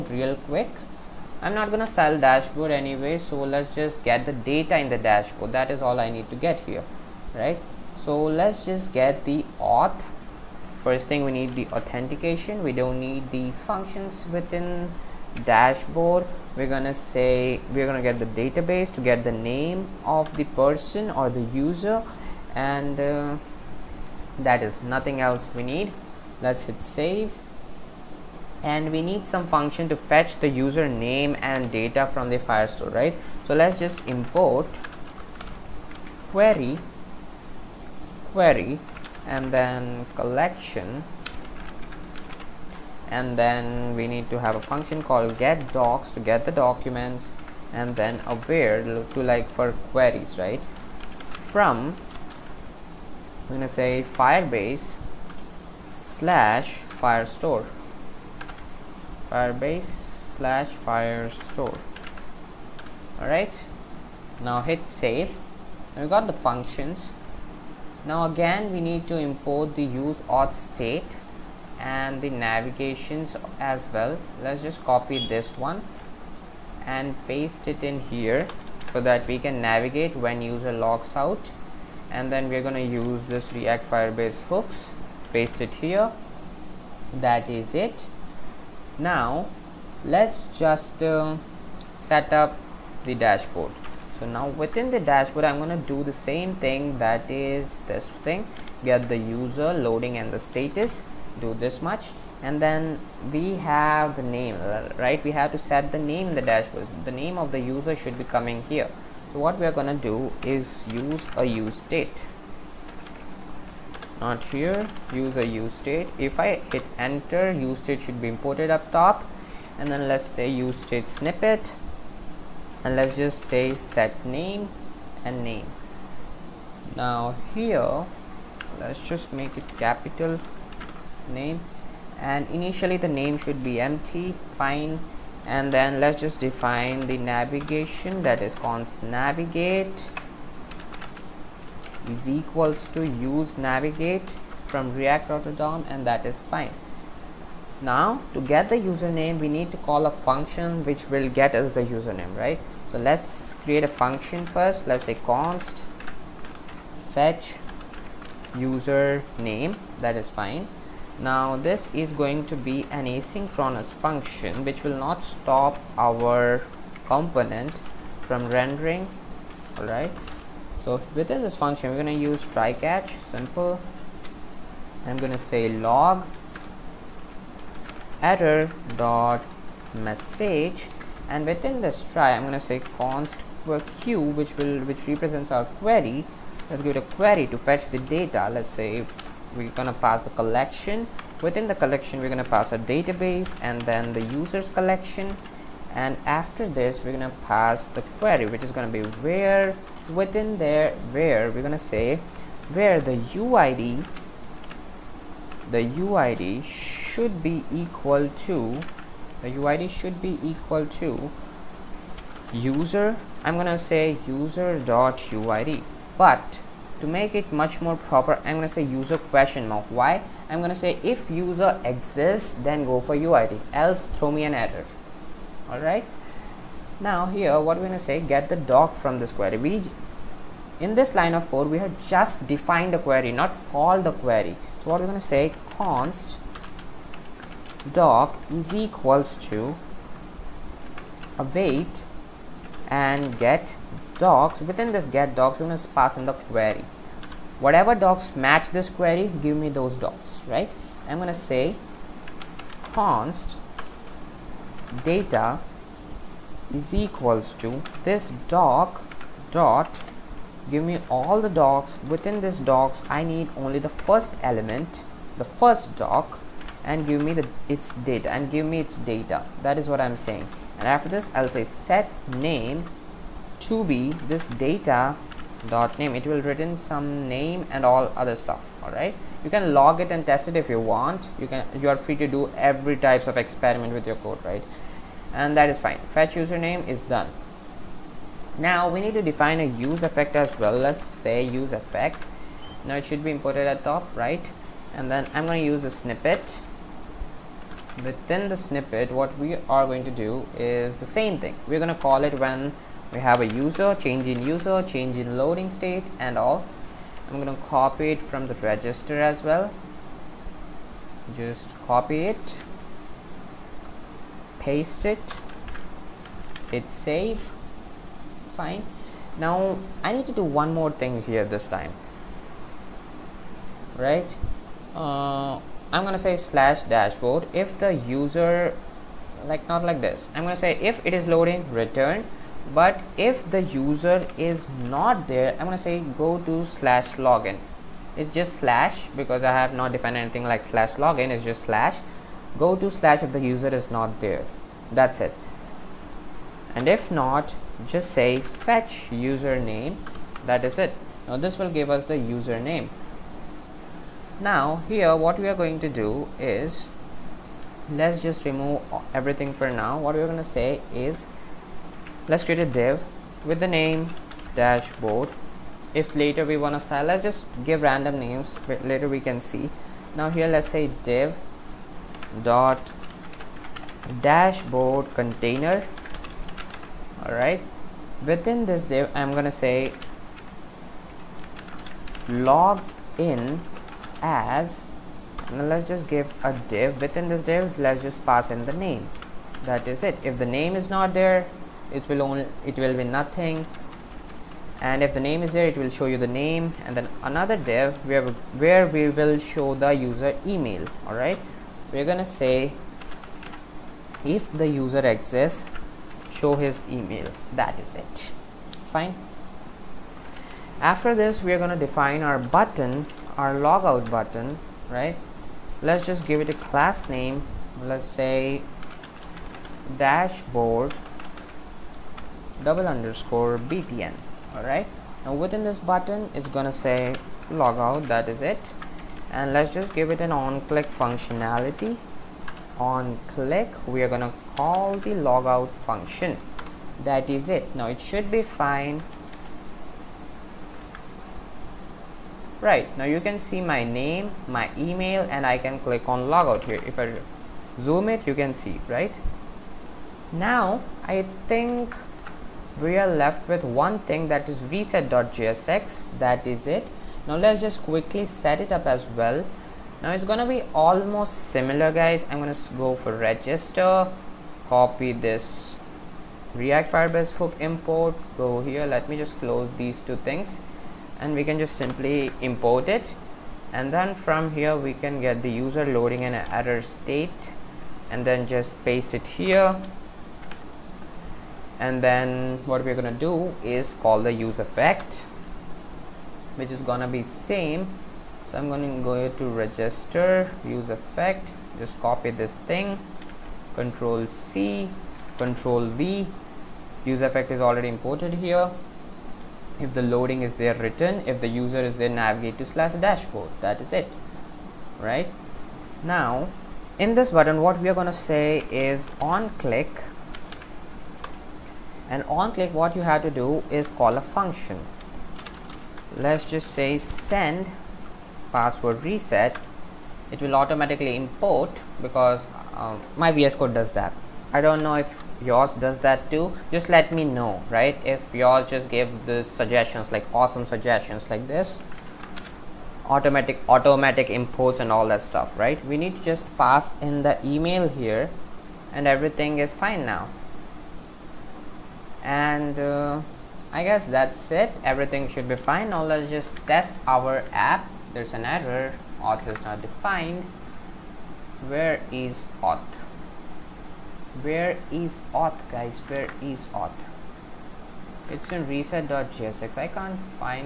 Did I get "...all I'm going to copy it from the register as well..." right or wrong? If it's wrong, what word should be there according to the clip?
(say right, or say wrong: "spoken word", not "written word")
right.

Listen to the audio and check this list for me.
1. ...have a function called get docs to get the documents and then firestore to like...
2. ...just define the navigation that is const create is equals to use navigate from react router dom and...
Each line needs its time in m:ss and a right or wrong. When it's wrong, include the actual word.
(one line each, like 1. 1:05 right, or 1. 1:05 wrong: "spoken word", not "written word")
1. 0:44 wrong: "aware", not "firestore"
2. 2:16 wrong: "navigate", not "create".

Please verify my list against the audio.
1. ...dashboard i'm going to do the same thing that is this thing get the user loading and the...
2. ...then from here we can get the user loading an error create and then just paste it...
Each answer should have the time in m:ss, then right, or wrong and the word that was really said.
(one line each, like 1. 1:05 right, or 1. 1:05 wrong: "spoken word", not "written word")
1. 1:34 right
2. 7:53 wrong: "state", not "create".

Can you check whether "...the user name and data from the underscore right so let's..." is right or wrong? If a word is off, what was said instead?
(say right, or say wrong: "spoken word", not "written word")
wrong: "firestore", not "underscore".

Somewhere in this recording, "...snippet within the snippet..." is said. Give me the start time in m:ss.
4:55.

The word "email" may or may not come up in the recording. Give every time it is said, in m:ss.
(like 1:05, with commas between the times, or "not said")
6:40, 6:46, 7:24, 8:57.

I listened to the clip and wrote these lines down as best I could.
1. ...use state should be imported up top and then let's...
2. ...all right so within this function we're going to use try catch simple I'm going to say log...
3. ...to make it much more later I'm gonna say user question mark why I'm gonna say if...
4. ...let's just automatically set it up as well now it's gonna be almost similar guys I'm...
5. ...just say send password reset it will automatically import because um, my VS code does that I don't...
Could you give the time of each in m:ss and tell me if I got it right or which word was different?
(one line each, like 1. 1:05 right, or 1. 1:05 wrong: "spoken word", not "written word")
1. 1:57 right
2. 2:49 right
3. 3:36 wrong: "proper", not "later"
4. 7:37 wrong: "quickly", not "automatically"
5. 8:36 right.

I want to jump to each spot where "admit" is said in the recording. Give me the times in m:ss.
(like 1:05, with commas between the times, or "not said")
not said.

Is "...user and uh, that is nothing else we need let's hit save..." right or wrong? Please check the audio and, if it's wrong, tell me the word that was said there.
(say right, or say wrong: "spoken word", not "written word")
right.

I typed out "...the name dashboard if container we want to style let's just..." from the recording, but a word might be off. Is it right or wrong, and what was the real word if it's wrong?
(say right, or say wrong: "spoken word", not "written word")
wrong: "later", not "container".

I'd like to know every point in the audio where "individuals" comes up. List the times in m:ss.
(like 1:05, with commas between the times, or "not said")
not said.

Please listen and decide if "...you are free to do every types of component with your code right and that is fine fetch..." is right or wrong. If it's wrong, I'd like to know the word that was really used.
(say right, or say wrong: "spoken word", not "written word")
wrong: "experiment", not "component".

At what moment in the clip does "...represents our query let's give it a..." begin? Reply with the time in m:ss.
3:05.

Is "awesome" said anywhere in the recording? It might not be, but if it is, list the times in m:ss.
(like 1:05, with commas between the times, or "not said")
8:50.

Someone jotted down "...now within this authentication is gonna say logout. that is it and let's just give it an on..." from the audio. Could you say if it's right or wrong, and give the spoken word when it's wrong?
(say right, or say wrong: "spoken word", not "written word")
wrong: "button", not "authentication".